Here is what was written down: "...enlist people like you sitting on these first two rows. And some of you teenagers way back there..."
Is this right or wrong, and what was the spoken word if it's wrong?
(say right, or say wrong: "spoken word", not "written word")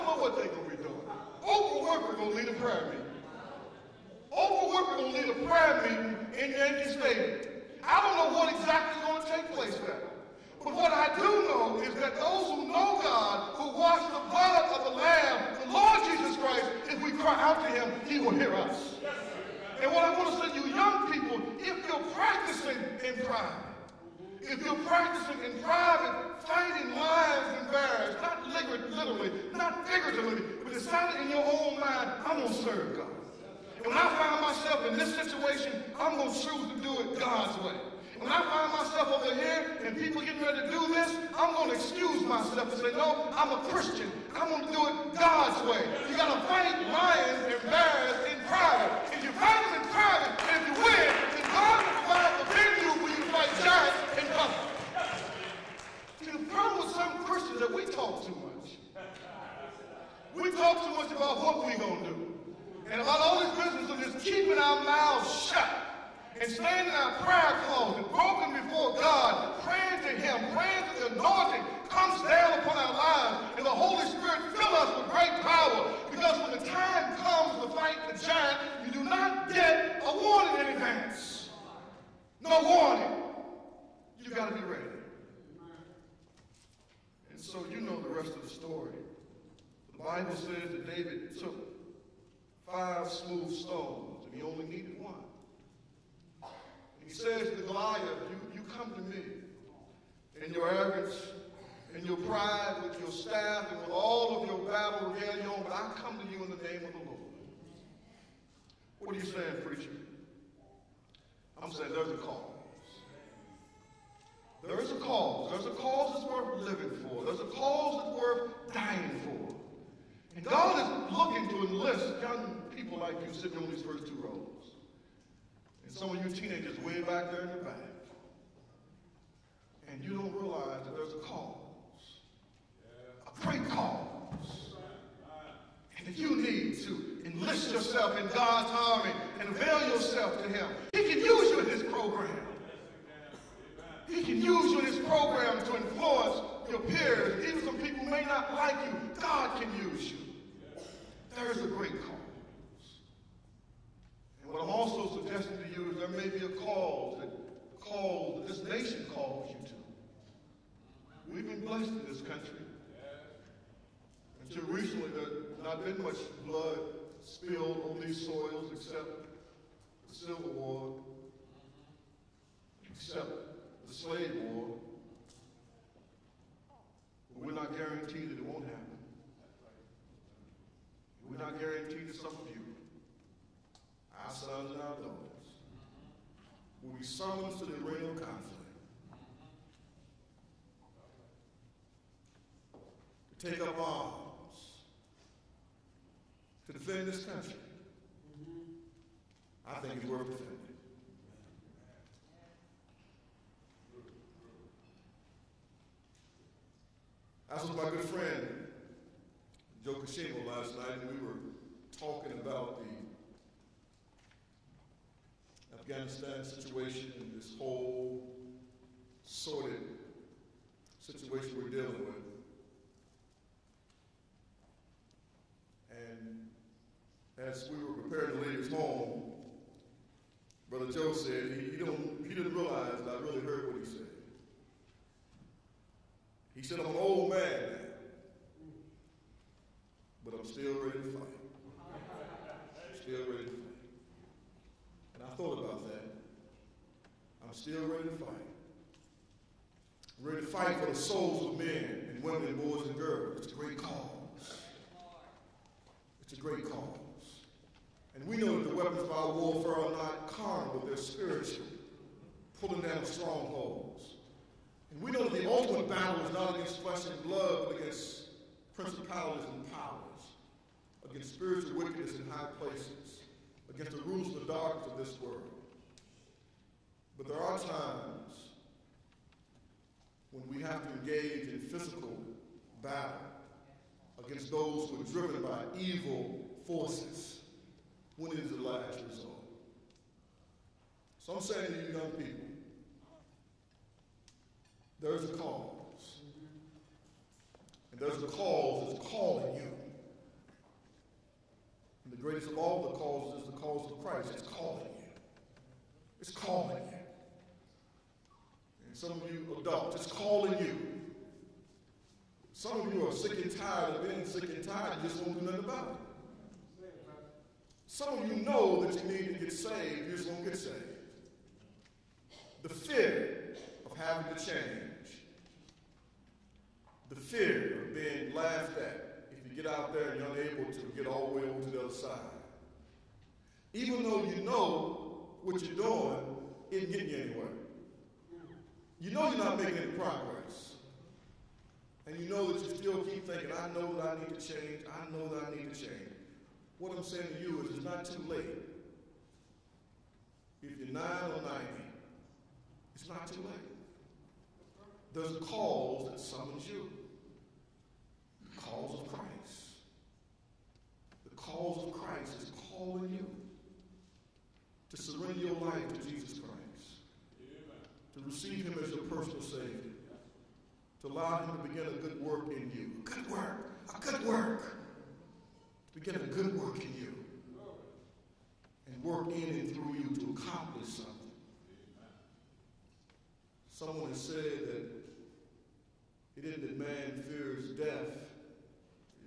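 right.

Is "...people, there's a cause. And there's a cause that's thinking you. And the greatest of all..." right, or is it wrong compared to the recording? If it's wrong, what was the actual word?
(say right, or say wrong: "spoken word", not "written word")
wrong: "calling", not "thinking".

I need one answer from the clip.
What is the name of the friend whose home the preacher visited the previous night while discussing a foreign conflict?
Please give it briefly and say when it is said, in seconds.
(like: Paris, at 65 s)
Joe Kashima, at 209 s.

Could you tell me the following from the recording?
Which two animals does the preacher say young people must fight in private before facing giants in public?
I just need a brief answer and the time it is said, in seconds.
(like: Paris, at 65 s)
lions and bears, at 46 s.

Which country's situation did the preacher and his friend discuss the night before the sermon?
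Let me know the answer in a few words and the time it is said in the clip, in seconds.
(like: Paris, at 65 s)
Afghanistan, at 215 s.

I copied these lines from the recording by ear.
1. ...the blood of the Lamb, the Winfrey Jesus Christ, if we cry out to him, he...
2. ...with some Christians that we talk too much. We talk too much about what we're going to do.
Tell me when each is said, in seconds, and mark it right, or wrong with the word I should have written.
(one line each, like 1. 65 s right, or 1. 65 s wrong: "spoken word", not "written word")
1. 14 s wrong: "Lord", not "Winfrey"
2. 56 s right.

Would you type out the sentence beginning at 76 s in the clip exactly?
Because when the time comes to fight the giant, you do not get a warning in advance.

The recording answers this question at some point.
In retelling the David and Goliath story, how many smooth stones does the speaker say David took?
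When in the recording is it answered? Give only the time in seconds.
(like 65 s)
92 s.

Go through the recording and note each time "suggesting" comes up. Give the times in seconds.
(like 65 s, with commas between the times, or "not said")
155 s.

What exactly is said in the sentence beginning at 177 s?
But we're not guaranteed that it won't happen.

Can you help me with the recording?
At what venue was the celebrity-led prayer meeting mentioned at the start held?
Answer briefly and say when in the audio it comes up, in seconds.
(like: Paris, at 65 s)
Yankee Stadium, at 6 s.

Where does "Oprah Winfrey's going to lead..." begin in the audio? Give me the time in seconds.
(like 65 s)
1 s.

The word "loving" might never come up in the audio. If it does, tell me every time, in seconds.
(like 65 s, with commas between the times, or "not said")
not said.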